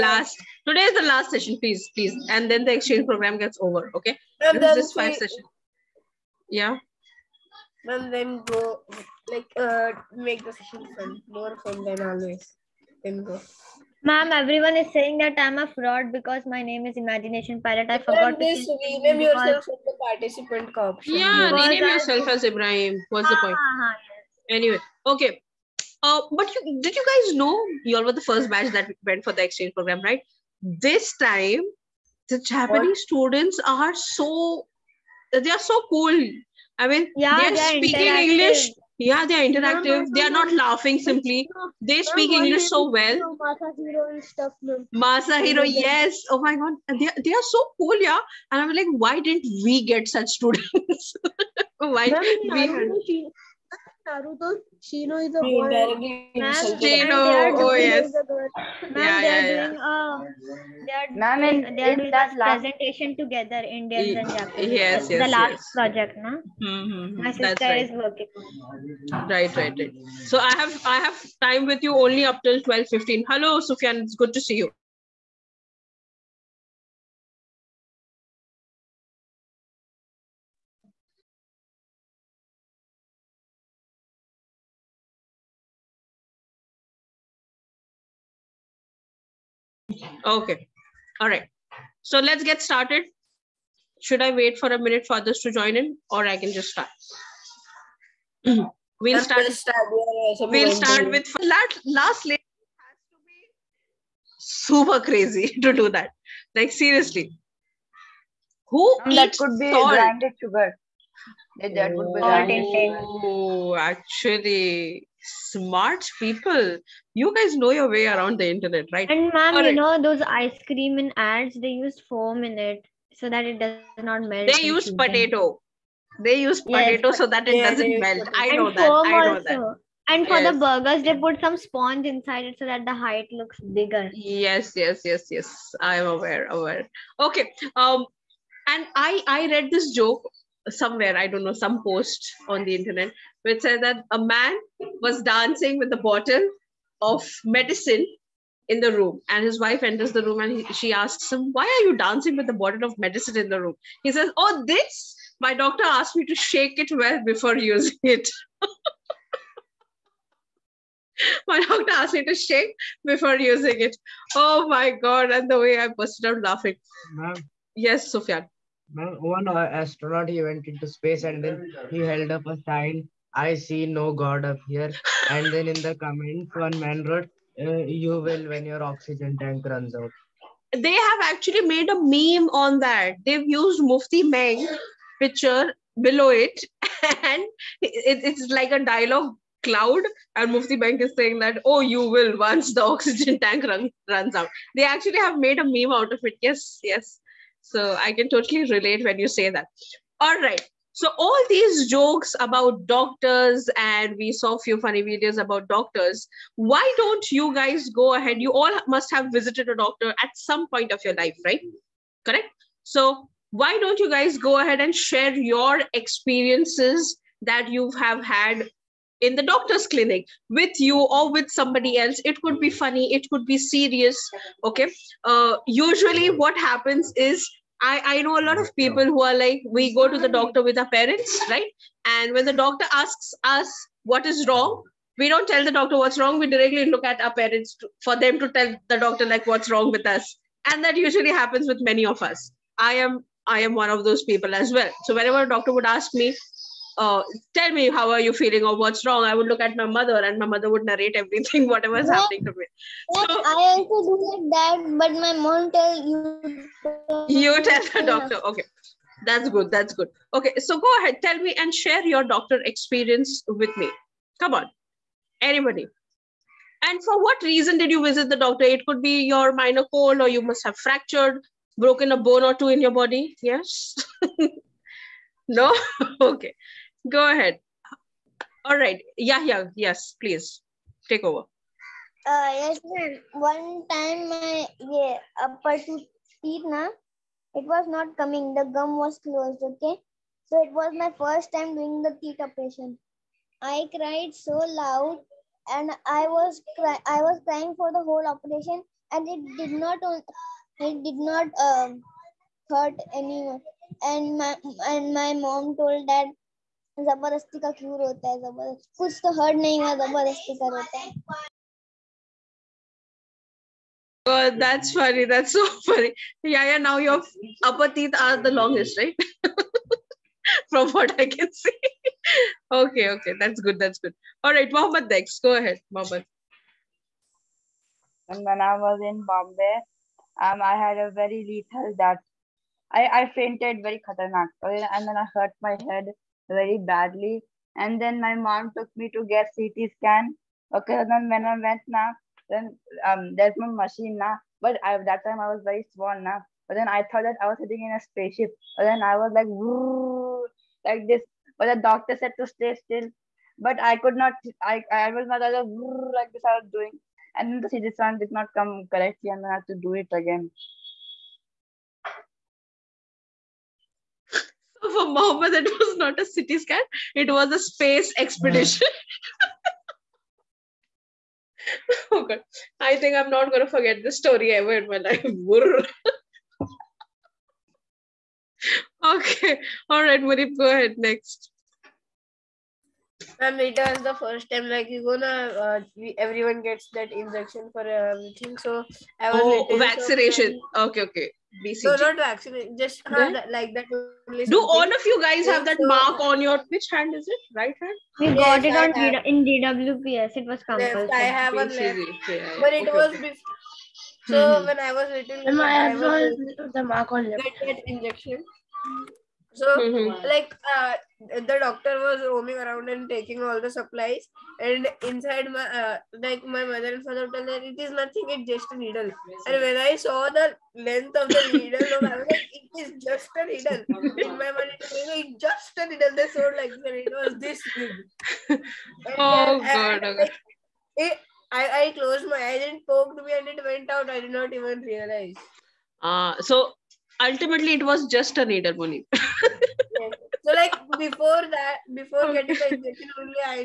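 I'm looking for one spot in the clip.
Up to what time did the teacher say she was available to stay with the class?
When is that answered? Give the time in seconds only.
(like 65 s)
72 s.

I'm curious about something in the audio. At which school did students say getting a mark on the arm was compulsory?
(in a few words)
DWPS.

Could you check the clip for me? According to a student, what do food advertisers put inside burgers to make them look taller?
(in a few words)
Sponge.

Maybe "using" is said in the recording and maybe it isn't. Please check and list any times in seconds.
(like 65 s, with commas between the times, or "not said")
157 s, 163 s.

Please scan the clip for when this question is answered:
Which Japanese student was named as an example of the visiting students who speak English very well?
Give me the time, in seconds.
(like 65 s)
43 s.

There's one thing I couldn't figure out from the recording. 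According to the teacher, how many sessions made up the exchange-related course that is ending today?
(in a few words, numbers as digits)
5.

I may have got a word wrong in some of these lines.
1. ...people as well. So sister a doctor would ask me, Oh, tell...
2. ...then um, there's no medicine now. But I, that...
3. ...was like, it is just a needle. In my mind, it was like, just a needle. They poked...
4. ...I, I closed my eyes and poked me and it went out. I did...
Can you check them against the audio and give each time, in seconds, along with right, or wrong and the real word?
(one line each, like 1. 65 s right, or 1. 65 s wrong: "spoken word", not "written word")
1. 244 s wrong: "whenever", not "sister"
2. 342 s wrong: "machine", not "medicine"
3. 421 s wrong: "showed", not "poked"
4. 431 s right.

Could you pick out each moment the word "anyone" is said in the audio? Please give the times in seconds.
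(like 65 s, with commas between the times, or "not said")
303 s.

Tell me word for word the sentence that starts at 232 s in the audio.
And when the doctor asks us what is wrong, we don't tell the doctor what's wrong.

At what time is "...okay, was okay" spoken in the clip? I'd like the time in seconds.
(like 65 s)
402 s.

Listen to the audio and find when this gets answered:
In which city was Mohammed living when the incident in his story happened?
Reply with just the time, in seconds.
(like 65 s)
329 s.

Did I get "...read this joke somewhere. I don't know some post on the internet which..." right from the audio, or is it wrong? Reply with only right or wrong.
right.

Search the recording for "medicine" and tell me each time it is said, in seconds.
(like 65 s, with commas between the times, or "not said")
147 s, 152 s.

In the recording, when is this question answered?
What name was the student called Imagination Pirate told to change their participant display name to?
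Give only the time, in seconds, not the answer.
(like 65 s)
22 s.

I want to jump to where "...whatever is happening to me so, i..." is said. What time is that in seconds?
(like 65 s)
251 s.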